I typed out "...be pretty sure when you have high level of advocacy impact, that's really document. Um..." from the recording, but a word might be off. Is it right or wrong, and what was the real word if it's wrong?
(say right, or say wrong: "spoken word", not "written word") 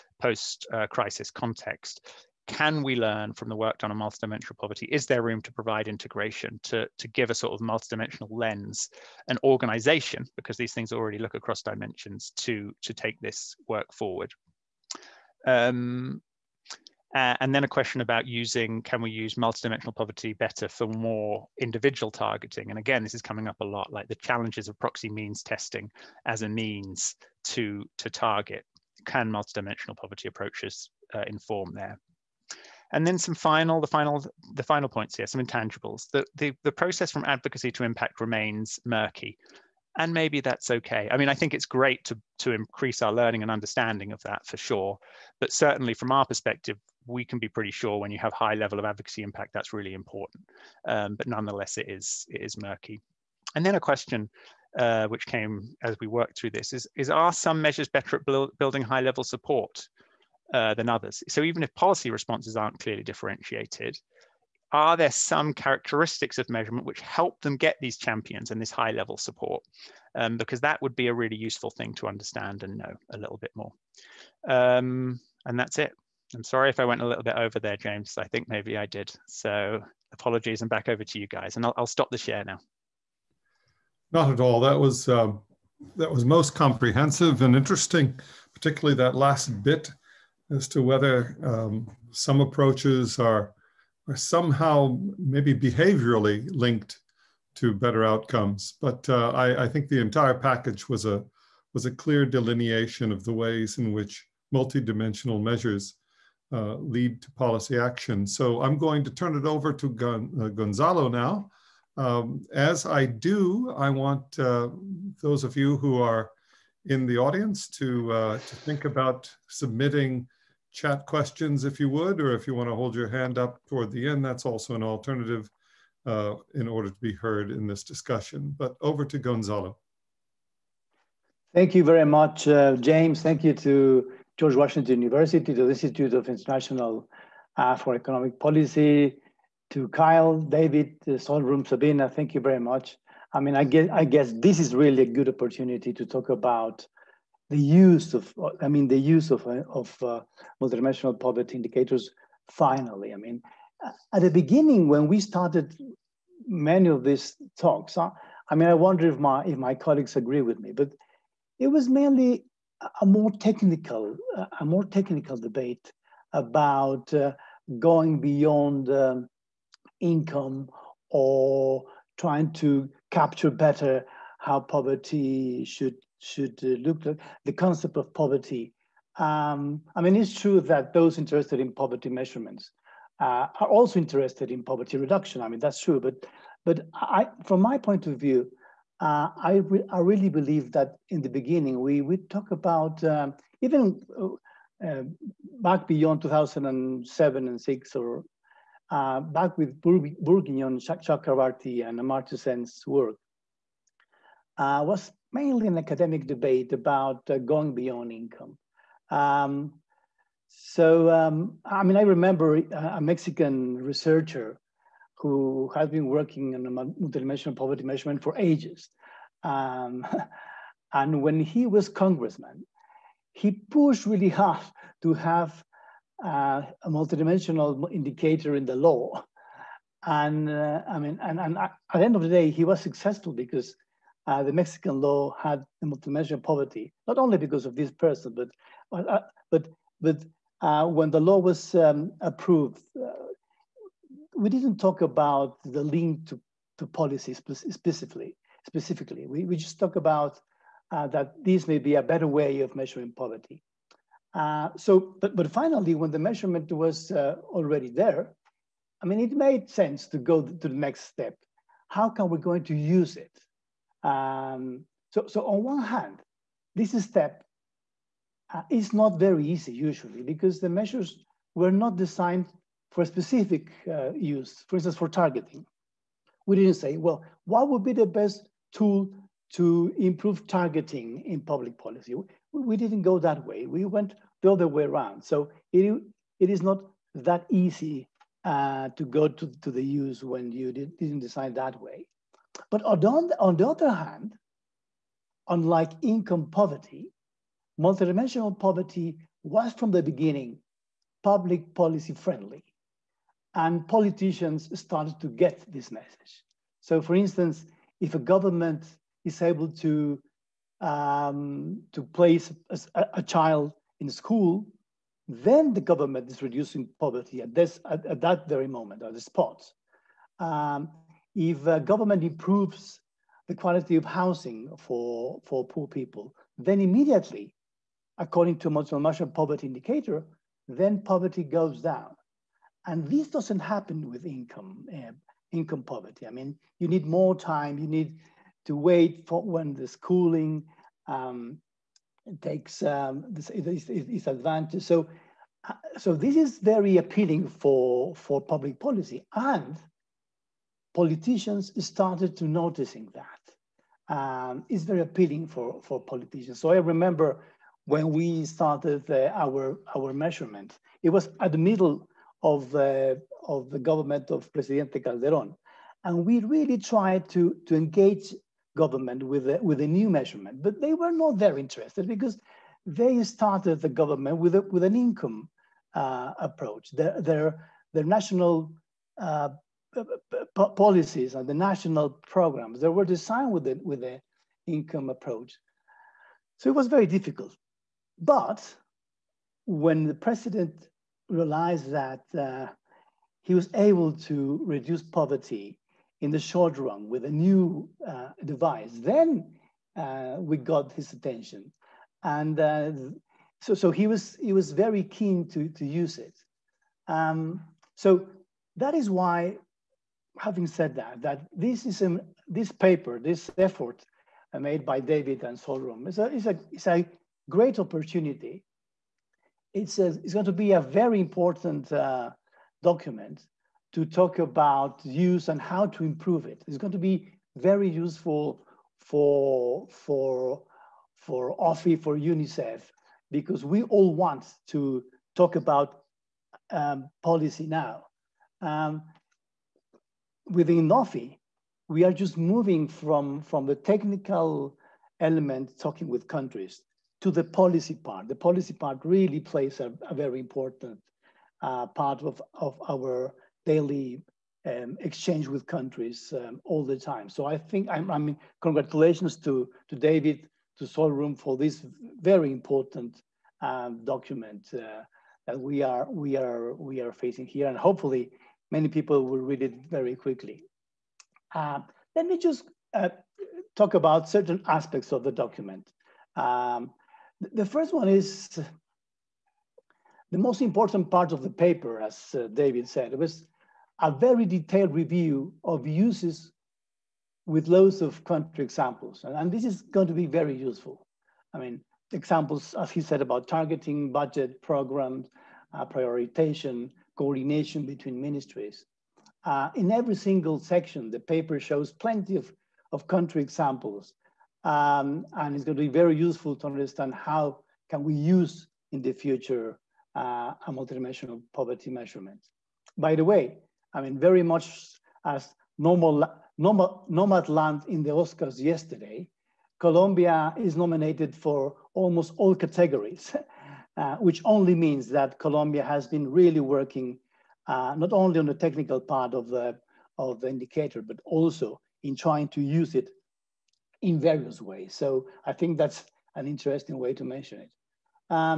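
wrong: "important", not "document".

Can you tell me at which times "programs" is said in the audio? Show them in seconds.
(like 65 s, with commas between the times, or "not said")
382 s, 494 s.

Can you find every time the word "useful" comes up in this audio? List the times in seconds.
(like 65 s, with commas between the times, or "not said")
71 s, 427 s, 490 s, 506 s.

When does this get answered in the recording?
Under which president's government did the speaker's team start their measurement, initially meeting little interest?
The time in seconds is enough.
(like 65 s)
364 s.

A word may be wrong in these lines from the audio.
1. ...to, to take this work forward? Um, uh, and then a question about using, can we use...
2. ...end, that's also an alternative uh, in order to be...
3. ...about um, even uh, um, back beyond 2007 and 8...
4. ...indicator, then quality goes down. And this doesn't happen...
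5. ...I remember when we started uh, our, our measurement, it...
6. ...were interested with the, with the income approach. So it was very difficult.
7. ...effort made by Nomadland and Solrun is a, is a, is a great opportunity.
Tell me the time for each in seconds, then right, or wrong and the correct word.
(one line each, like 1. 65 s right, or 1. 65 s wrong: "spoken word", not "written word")
1. 12 s right
2. 124 s right
3. 192 s wrong: "6", not "8"
4. 329 s wrong: "poverty", not "quality"
5. 356 s right
6. 382 s wrong: "designed", not "interested"
7. 413 s wrong: "David", not "Nomadland".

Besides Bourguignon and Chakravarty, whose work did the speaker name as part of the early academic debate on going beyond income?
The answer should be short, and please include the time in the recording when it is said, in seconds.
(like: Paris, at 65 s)
Amartya Sen, at 201 s.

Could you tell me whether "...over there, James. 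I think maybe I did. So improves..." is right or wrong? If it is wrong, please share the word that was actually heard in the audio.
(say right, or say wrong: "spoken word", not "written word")
wrong: "apologies", not "improves".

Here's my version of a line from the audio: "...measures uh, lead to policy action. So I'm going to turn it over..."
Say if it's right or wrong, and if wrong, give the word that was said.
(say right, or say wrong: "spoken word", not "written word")
right.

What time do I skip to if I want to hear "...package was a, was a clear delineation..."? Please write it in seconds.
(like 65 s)
100 s.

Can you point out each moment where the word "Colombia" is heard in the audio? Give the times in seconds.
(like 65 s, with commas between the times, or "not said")
519 s, 525 s.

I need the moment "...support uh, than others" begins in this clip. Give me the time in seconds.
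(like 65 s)
59 s.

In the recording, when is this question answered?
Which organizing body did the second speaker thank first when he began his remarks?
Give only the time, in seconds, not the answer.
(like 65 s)
134 s.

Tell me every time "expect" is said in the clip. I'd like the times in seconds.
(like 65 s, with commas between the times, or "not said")
not said.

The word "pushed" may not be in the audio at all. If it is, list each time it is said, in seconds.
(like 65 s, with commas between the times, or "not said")
223 s.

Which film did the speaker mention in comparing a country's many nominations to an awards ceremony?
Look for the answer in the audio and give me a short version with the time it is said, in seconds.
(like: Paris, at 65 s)
Nomadland, at 517 s.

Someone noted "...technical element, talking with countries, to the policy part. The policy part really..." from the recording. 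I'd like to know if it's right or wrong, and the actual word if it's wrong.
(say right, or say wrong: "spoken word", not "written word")
right.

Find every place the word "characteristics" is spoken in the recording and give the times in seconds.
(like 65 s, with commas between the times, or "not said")
65 s.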